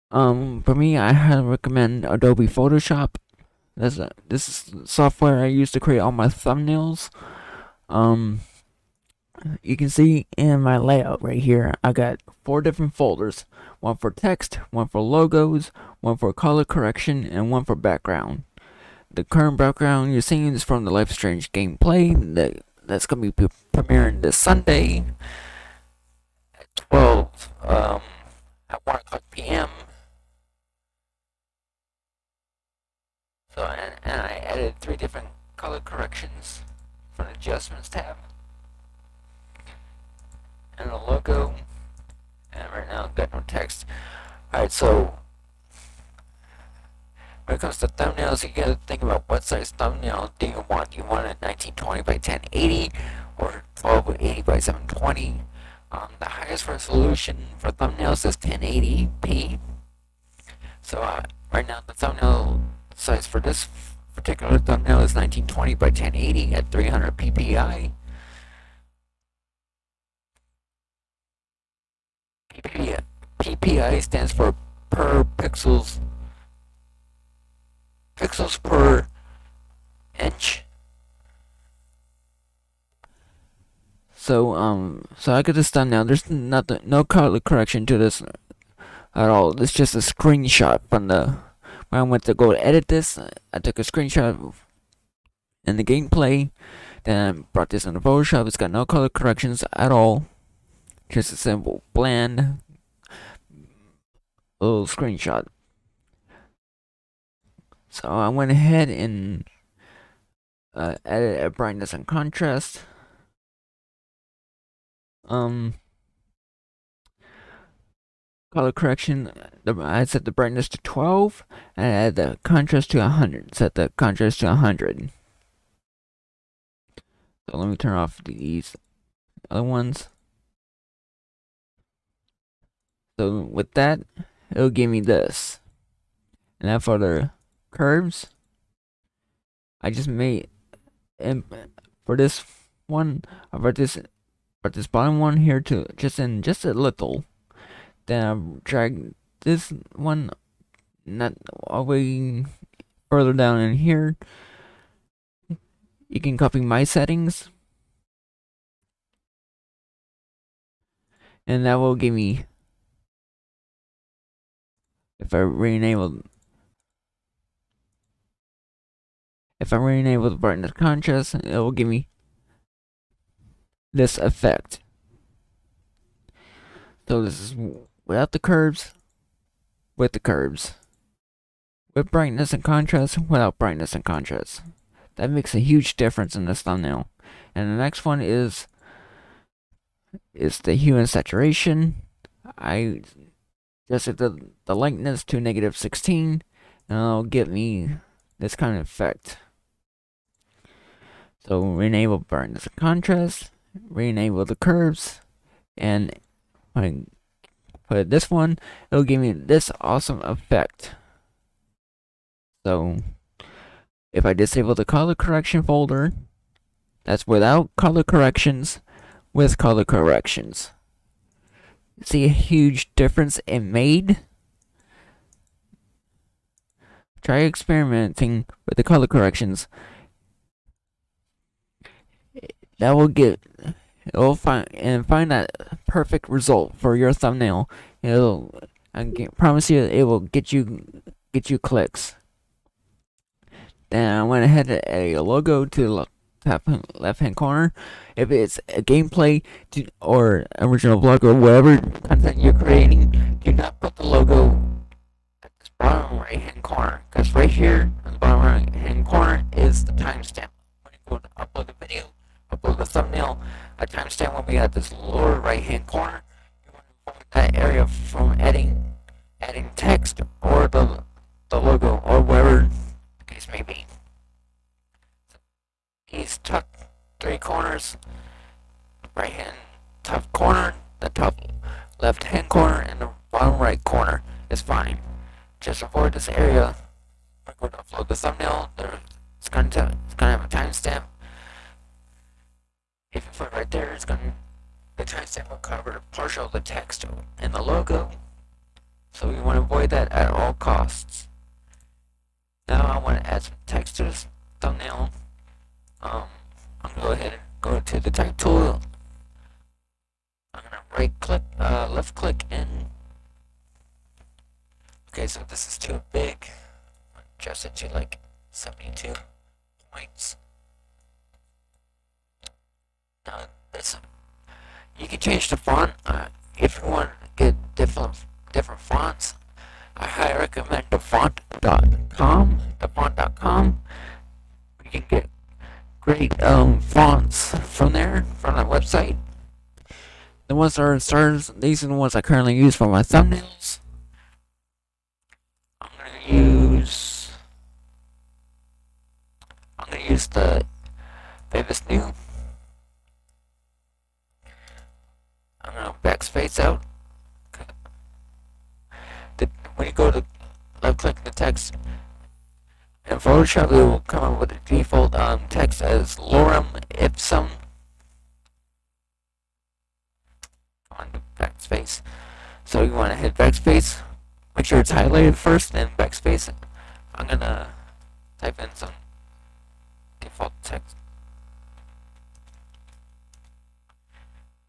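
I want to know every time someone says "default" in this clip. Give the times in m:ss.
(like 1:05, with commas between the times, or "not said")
6:04, 6:20.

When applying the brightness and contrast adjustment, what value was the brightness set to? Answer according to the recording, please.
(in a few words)
12.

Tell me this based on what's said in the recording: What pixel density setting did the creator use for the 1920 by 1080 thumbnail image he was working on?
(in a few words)
300 ppi.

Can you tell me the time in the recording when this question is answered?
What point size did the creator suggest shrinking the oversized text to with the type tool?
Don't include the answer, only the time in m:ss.
5:18.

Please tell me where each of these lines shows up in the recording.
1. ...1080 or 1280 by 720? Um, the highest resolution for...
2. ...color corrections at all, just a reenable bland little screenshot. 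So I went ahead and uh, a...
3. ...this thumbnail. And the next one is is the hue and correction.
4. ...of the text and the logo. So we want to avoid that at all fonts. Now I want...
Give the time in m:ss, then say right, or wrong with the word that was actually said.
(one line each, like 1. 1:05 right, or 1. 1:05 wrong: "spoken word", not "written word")
1. 0:52 right
2. 1:38 wrong: "simple", not "reenable"
3. 3:06 wrong: "saturation", not "correction"
4. 4:56 wrong: "costs", not "fonts".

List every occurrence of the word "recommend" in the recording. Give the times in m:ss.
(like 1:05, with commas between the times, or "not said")
0:01, 5:30.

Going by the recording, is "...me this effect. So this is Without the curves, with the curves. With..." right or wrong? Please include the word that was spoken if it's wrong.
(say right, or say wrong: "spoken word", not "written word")
right.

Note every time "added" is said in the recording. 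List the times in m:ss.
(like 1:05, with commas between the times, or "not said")
0:34, 4:04.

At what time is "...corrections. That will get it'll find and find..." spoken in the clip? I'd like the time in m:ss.
3:49.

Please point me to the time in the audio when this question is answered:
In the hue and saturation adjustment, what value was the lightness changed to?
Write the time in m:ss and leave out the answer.
3:15.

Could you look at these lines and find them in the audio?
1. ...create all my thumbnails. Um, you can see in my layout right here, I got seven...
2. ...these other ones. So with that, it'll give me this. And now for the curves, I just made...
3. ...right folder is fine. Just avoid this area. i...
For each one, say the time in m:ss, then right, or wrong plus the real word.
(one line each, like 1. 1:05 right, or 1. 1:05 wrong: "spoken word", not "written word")
1. 0:05 wrong: "four", not "seven"
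2. 2:08 right
3. 4:43 wrong: "corner", not "folder".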